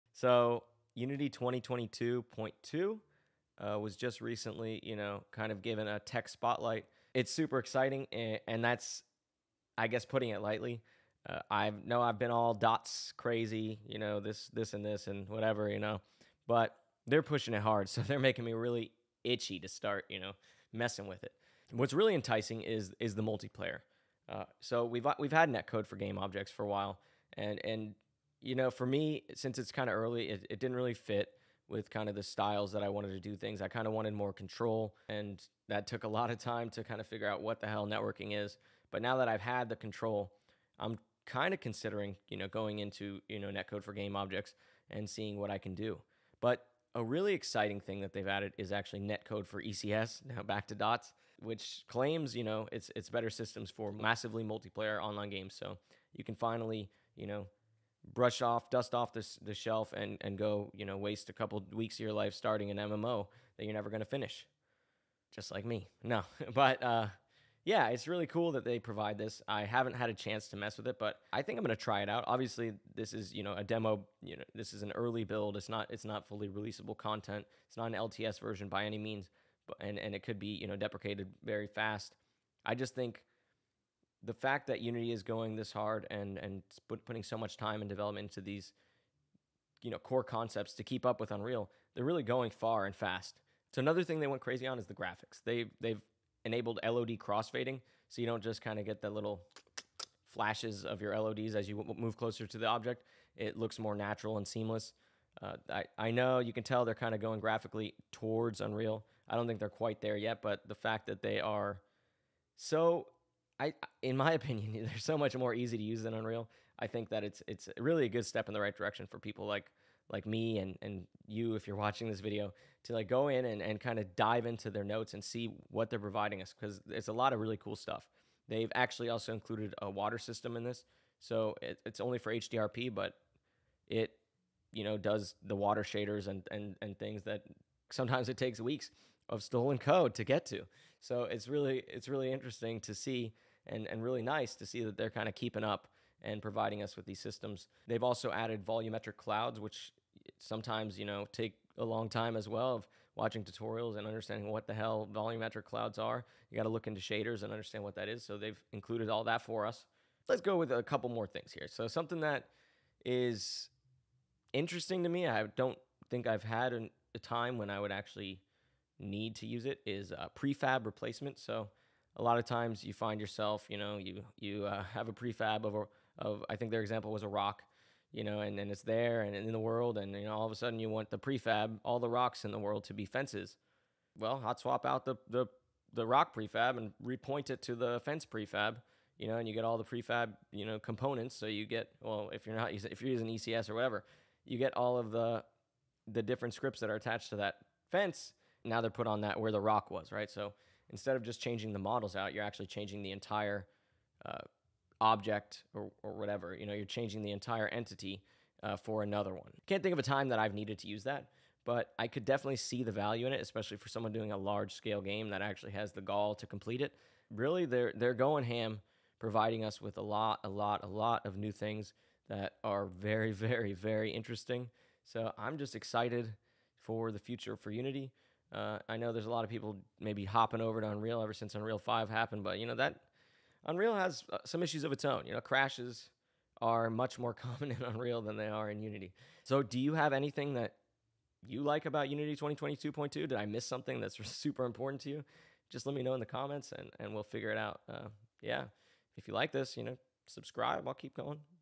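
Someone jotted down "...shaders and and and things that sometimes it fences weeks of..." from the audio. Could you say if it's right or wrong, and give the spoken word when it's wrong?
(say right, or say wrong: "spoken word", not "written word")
wrong: "takes", not "fences".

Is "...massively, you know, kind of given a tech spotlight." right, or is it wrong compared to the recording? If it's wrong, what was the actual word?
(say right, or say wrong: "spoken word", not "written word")
wrong: "recently", not "massively".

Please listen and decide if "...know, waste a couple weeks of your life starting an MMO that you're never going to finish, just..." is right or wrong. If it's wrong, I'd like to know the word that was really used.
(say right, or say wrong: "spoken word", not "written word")
right.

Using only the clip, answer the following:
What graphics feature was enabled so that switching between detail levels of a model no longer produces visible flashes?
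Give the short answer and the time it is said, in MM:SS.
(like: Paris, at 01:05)
LOD crossfading, at 01:36.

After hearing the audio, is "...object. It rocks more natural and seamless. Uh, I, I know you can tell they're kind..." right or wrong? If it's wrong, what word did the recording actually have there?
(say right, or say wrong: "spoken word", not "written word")
wrong: "looks", not "rocks".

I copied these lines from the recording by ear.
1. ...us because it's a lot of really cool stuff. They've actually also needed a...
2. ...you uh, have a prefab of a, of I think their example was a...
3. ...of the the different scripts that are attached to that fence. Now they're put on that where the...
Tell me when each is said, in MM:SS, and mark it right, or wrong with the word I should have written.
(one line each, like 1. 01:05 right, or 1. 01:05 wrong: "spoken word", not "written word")
1. 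02:06 wrong: "included", not "needed"
2. 02:54 right
3. 03:14 right.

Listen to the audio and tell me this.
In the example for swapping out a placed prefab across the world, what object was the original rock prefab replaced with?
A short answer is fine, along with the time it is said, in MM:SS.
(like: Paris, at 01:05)
Fences, at 03:03.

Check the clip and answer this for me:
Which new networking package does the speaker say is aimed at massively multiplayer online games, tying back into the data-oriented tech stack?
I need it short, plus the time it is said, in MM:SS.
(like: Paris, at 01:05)
Netcode for ECS, at 00:49.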